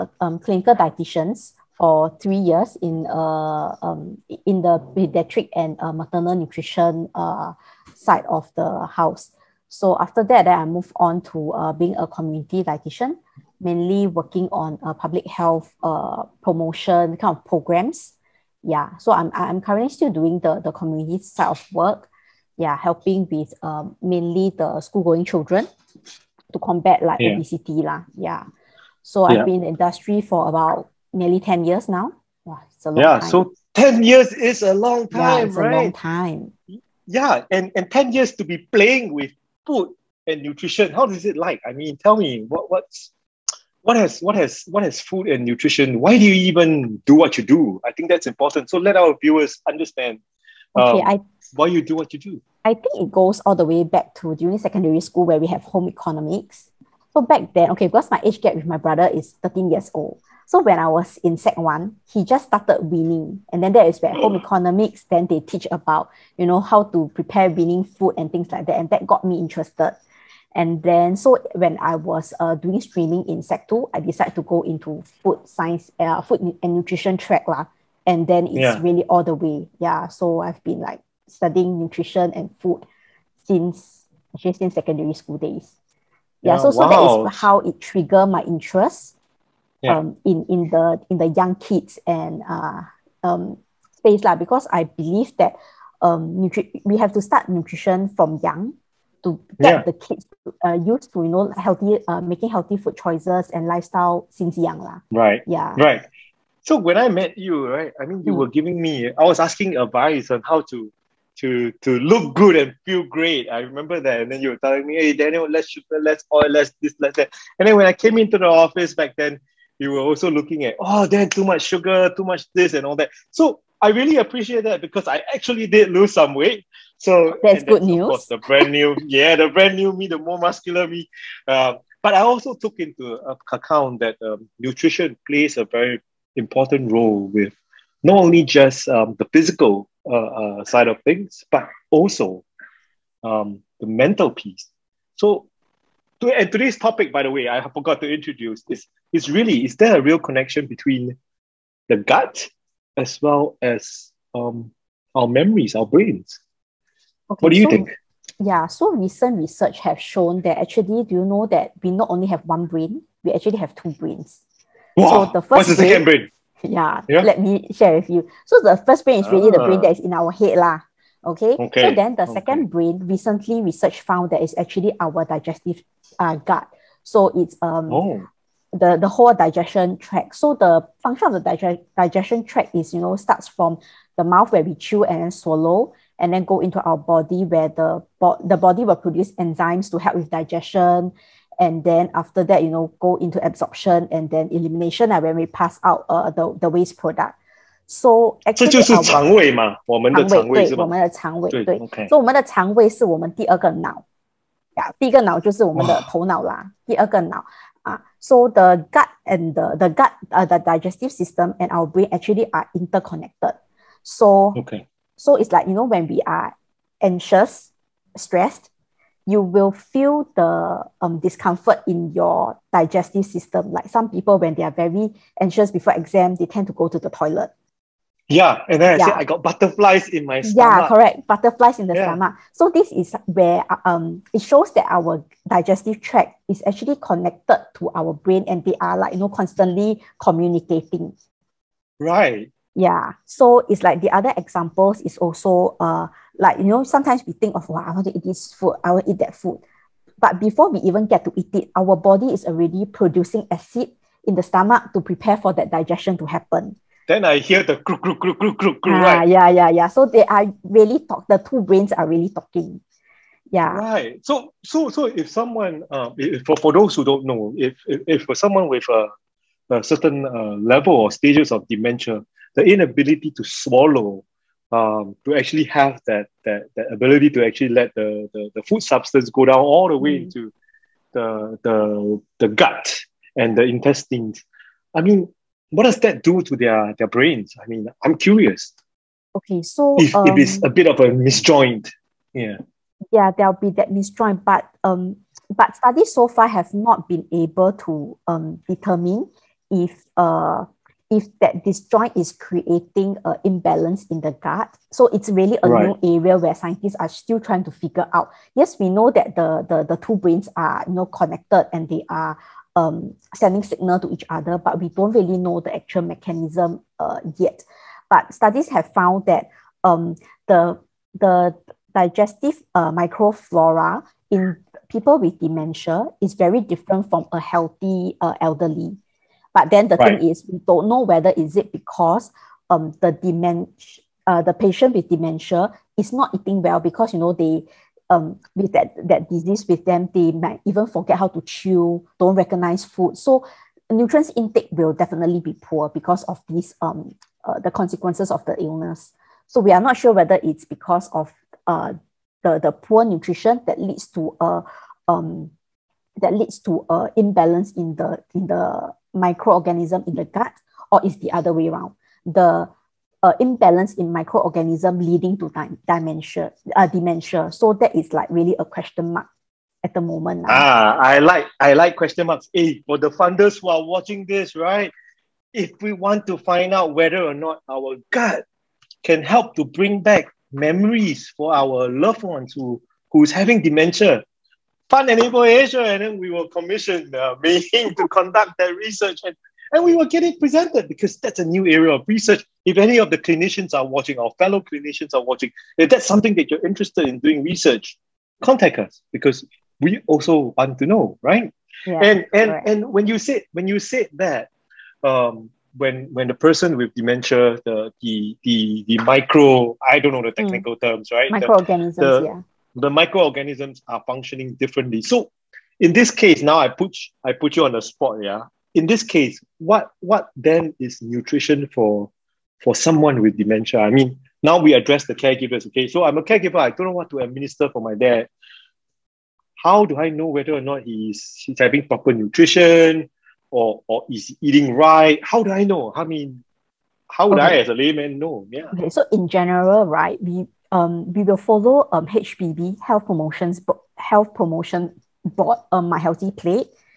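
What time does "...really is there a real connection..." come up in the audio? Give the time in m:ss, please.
2:29.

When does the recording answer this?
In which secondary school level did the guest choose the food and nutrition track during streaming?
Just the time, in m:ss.
1:13.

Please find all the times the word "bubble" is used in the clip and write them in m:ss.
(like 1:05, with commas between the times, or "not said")
not said.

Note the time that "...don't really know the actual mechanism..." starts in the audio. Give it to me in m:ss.
5:14.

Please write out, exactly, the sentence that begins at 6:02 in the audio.
The uh, imbalance in microorganism leading to di- dementia, uh, dementia.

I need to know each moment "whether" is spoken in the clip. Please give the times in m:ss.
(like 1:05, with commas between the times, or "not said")
5:31, 5:50, 6:16, 7:10.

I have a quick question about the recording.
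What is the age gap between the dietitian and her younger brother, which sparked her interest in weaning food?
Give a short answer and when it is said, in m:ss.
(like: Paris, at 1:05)
13 years, at 0:59.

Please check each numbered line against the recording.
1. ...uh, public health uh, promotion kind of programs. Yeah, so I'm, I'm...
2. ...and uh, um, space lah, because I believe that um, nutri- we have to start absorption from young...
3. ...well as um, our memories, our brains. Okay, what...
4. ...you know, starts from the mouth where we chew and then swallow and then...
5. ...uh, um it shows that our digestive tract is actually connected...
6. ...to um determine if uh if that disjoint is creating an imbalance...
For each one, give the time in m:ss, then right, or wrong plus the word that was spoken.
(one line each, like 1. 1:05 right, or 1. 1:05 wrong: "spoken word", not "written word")
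1. 0:14 right
2. 1:32 wrong: "nutrition", not "absorption"
3. 2:33 right
4. 3:02 right
5. 3:53 right
6. 4:57 right.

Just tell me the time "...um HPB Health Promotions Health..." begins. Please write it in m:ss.
7:21.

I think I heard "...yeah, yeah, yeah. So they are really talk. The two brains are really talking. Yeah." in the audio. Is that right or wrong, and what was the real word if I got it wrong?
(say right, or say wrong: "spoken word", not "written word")
right.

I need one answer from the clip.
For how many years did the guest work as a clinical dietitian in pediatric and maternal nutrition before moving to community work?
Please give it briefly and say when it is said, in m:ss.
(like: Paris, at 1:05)
3, at 0:02.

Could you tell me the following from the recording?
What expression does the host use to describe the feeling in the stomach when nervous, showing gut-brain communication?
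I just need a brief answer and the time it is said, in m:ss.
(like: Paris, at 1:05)
Butterflies in my stomach, at 3:49.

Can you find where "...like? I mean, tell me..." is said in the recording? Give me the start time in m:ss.
0:41.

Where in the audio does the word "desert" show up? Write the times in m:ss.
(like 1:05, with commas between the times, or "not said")
not said.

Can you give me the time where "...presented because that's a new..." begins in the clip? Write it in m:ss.
6:30.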